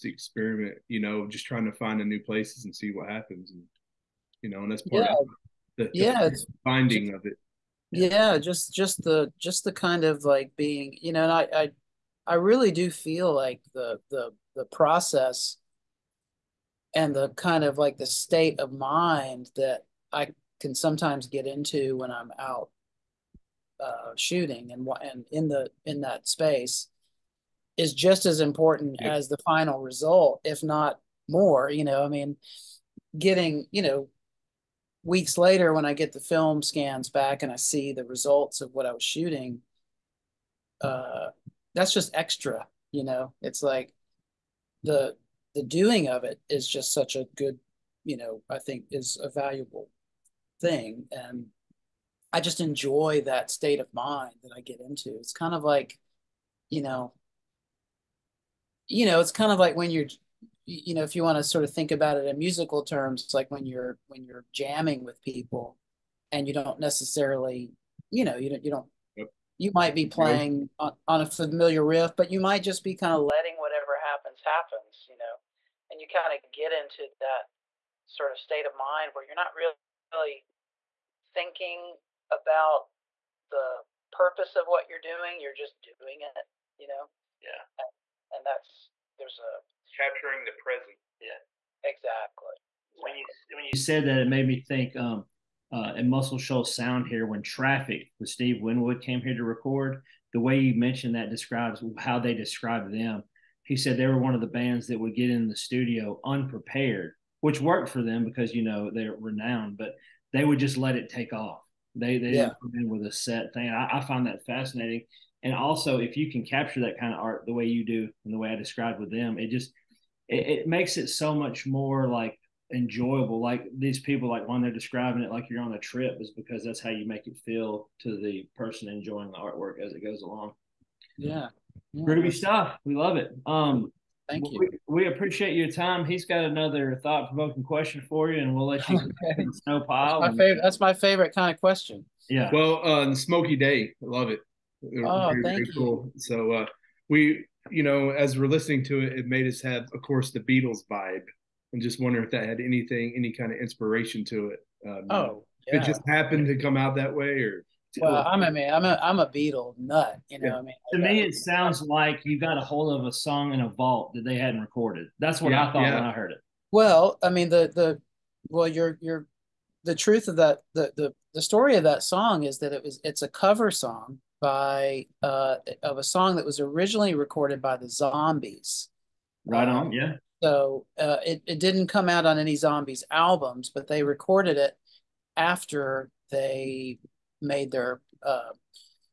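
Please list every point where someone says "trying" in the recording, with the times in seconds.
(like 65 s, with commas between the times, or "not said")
1 s.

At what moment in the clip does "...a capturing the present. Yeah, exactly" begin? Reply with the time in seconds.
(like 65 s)
89 s.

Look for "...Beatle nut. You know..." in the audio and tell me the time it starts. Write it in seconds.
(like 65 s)
159 s.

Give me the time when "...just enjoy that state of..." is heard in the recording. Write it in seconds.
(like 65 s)
52 s.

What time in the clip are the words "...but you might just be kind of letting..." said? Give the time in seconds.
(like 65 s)
72 s.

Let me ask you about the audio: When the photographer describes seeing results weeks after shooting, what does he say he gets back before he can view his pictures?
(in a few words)
film scans.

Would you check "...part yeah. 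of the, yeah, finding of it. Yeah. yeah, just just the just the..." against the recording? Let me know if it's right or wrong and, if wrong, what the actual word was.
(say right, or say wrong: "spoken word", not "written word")
right.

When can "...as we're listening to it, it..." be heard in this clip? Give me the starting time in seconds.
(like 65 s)
148 s.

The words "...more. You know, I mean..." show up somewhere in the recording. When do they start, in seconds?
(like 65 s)
31 s.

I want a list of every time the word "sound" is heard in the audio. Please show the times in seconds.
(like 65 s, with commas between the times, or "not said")
96 s, 161 s.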